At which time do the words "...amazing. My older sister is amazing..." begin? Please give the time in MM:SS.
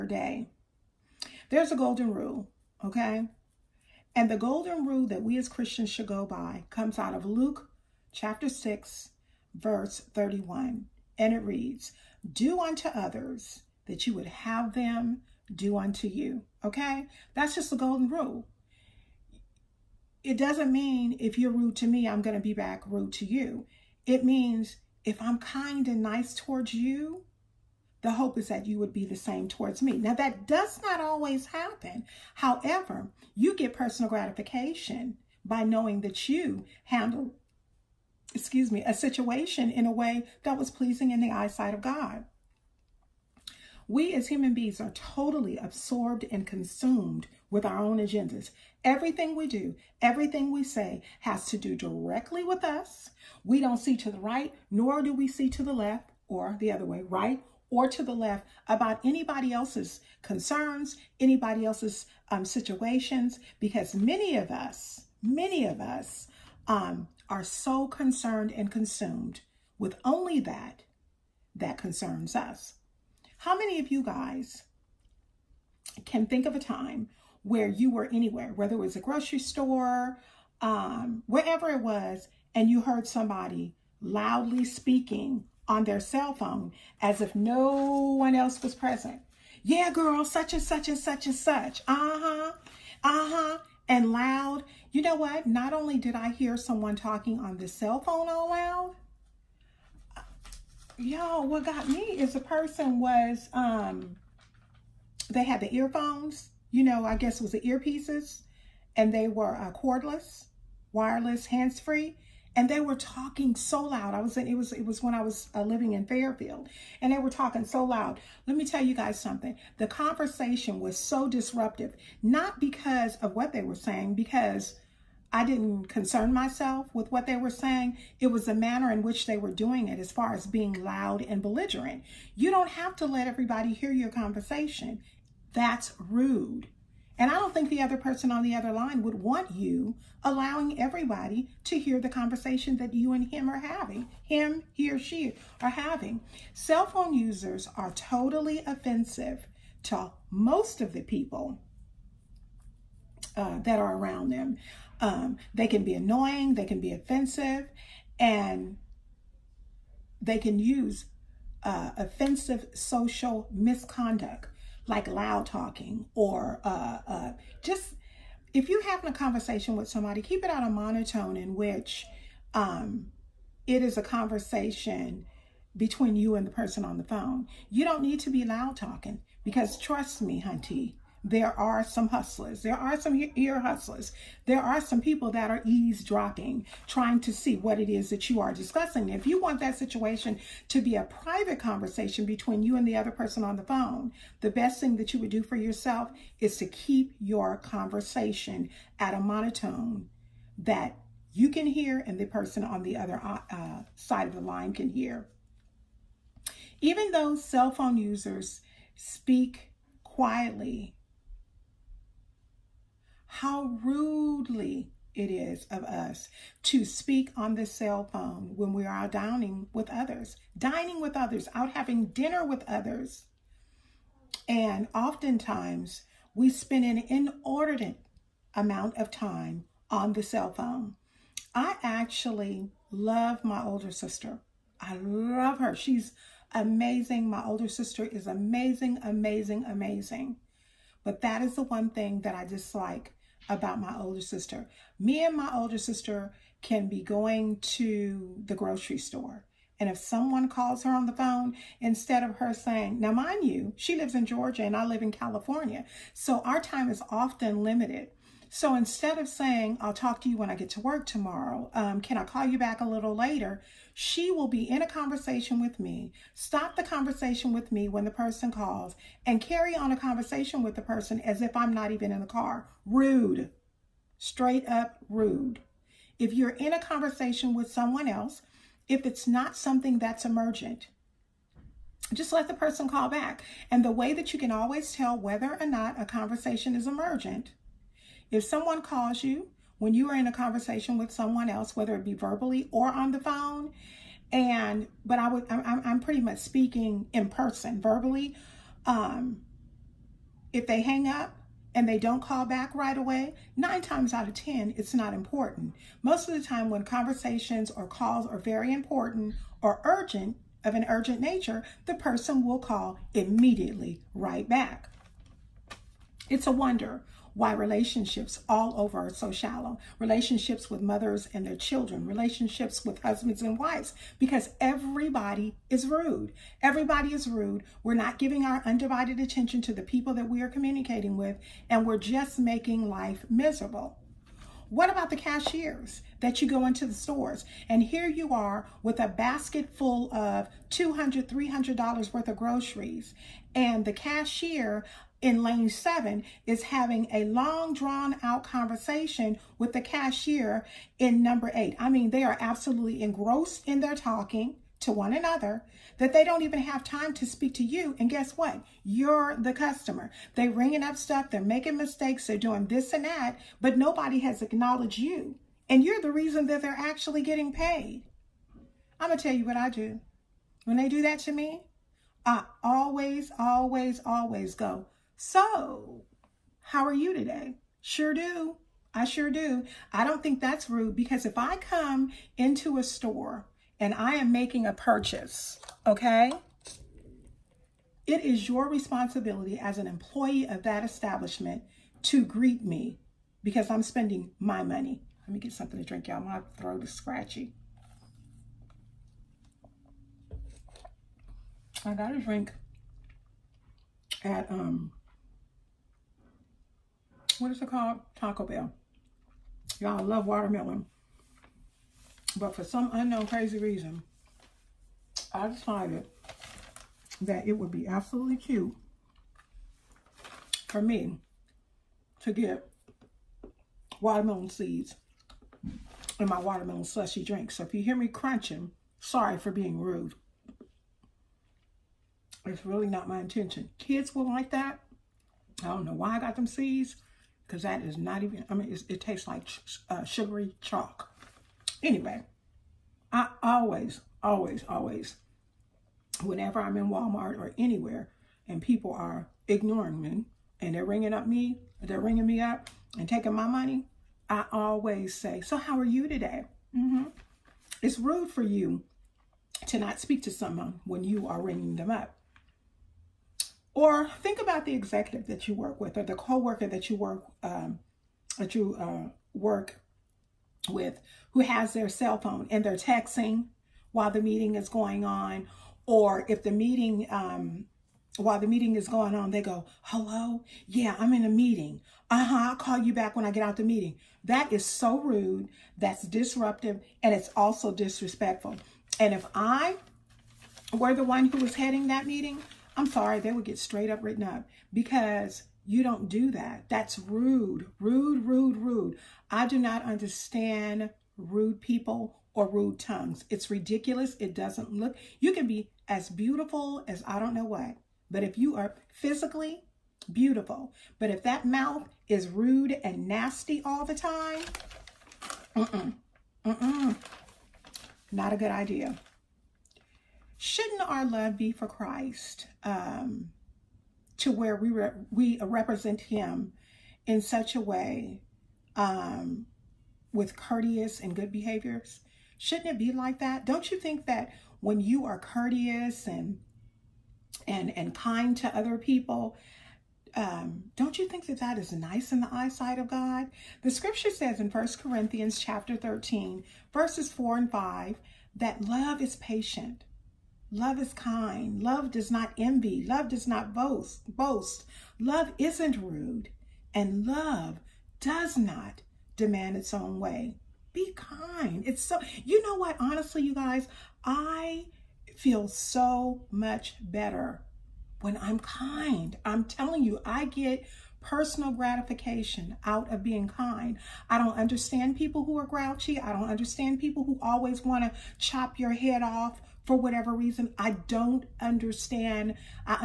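03:56.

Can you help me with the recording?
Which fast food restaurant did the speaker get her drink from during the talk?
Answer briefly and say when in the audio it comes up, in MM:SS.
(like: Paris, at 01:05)
Taco Bell, at 06:48.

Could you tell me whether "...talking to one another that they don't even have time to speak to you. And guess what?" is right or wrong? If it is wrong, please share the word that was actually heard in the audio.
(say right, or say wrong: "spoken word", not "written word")
right.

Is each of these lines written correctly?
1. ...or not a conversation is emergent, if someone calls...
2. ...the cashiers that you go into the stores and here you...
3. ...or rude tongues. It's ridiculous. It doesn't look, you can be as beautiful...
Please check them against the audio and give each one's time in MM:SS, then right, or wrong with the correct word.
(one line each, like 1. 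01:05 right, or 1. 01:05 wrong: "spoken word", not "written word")
1. 04:45 right
2. 05:35 right
3. 08:22 right.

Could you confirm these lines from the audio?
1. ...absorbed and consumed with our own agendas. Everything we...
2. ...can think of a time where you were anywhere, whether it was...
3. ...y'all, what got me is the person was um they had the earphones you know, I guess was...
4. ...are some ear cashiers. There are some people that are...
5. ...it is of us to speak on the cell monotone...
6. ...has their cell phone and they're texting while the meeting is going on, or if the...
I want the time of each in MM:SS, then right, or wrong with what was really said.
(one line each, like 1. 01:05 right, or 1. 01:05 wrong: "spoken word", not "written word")
1. 00:45 right
2. 01:16 right
3. 01:40 right
4. 03:02 wrong: "hustlers", not "cashiers"
5. 03:35 wrong: "phone", not "monotone"
6. 07:51 right.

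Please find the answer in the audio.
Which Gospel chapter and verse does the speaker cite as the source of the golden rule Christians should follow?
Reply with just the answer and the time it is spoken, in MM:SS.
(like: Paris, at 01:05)
Luke 6:31, at 00:07.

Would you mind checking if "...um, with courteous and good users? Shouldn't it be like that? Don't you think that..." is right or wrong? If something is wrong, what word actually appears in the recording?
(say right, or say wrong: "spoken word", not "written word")
wrong: "behaviors", not "users".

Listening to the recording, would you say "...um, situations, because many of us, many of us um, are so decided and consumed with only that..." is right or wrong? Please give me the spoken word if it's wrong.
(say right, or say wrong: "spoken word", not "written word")
wrong: "concerned", not "decided".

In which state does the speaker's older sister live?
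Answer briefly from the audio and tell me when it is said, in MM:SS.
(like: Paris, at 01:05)
Georgia, at 04:14.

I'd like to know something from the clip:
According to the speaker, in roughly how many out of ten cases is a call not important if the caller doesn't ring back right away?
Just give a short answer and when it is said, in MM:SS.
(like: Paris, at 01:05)
9, at 05:03.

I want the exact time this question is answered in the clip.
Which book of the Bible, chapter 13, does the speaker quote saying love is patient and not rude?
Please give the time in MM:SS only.
09:04.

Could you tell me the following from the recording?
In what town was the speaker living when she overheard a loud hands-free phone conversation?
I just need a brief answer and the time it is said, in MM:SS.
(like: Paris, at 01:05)
Fairfield, at 01:56.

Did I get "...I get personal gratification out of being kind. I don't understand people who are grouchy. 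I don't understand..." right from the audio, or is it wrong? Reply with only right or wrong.
right.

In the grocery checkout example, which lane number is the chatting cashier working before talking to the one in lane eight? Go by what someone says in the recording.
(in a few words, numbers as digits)
7.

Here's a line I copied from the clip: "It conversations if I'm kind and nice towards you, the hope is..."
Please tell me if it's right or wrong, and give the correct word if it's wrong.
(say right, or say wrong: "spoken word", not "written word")
wrong: "means", not "conversations".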